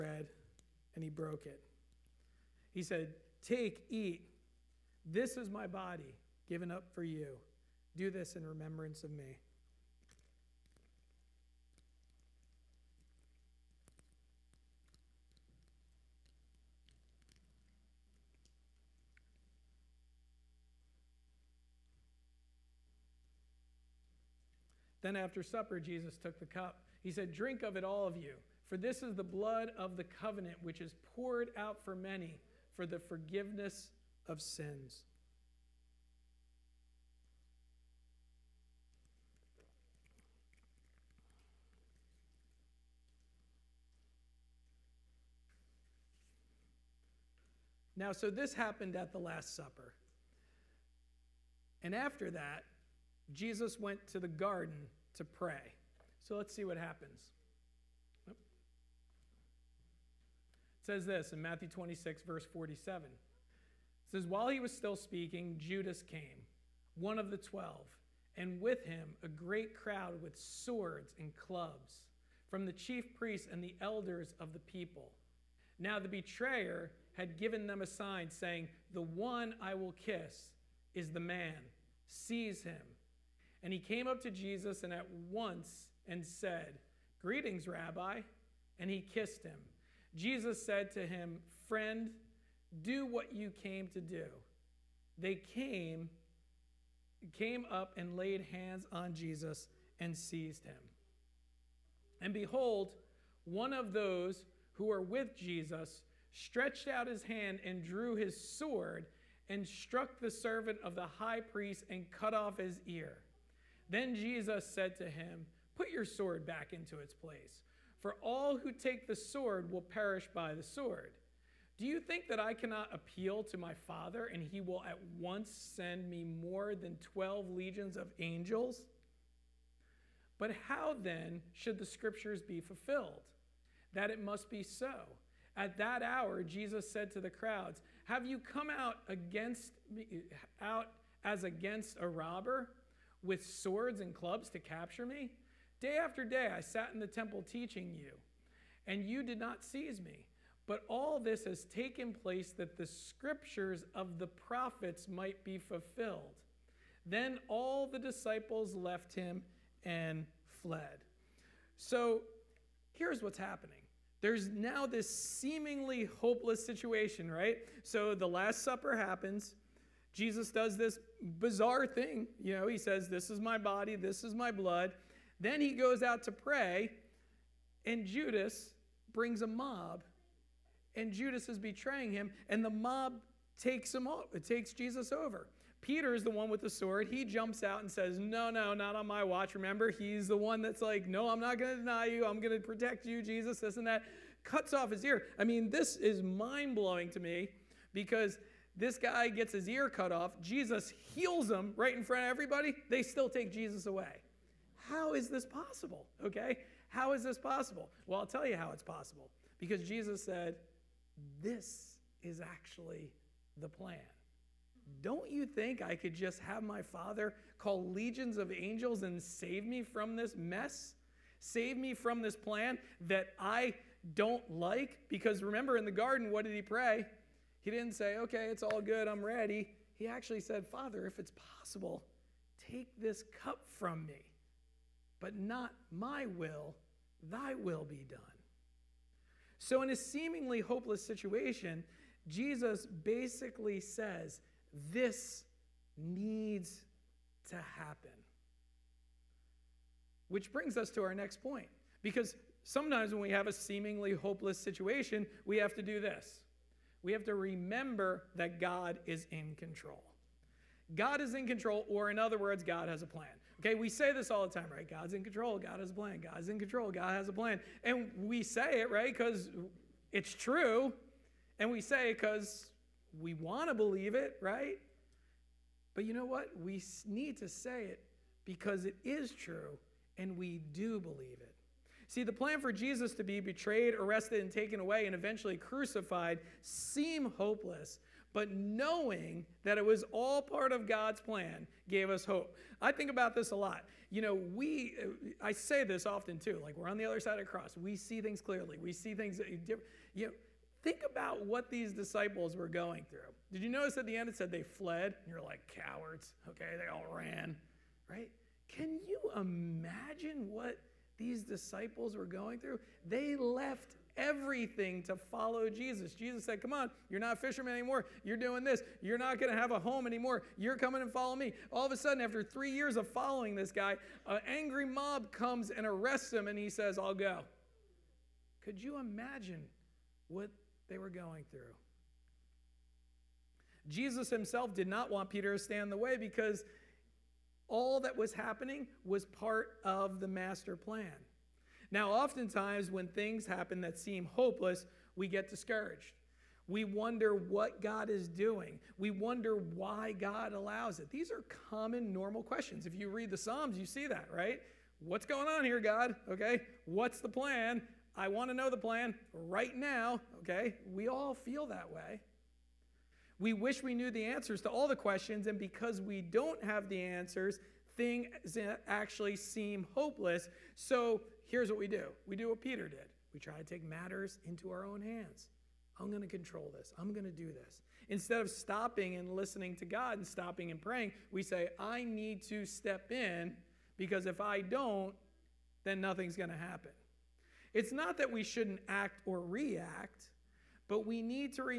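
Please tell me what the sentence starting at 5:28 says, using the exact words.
Could you imagine what they were going through?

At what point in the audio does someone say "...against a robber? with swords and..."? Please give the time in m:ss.
2:21.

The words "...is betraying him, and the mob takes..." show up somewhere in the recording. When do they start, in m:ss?
3:01.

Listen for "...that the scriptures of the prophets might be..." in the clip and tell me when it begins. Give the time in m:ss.
2:32.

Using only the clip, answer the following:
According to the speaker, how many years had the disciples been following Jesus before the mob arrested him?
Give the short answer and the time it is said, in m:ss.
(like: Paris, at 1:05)
3, at 5:22.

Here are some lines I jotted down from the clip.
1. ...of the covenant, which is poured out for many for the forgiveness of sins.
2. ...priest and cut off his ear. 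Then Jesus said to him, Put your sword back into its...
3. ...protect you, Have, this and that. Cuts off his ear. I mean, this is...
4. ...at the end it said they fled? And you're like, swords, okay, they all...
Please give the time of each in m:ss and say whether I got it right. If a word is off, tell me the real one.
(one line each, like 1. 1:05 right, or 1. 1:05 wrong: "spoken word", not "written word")
1. 0:29 right
2. 1:51 right
3. 3:12 wrong: "Jesus", not "Have"
4. 5:03 wrong: "cowards", not "swords".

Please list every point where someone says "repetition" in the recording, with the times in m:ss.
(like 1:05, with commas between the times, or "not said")
not said.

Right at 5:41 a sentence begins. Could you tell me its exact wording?
Now, oftentimes when things happen that seem hopeless, we get discouraged.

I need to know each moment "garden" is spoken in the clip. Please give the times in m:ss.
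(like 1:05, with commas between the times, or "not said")
0:54, 3:45.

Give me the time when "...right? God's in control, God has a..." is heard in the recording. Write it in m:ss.
4:24.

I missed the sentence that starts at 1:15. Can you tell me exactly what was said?
Now the betrayer had given them a sign saying, The one I will kiss is the man.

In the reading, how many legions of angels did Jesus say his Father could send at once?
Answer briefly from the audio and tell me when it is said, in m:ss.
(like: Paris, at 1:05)
12, at 2:07.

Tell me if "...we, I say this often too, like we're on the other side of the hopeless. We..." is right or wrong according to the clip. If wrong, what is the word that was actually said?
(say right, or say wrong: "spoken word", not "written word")
wrong: "cross", not "hopeless".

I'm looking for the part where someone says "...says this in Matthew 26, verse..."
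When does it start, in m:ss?
1:00.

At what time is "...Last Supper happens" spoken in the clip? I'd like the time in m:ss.
2:48.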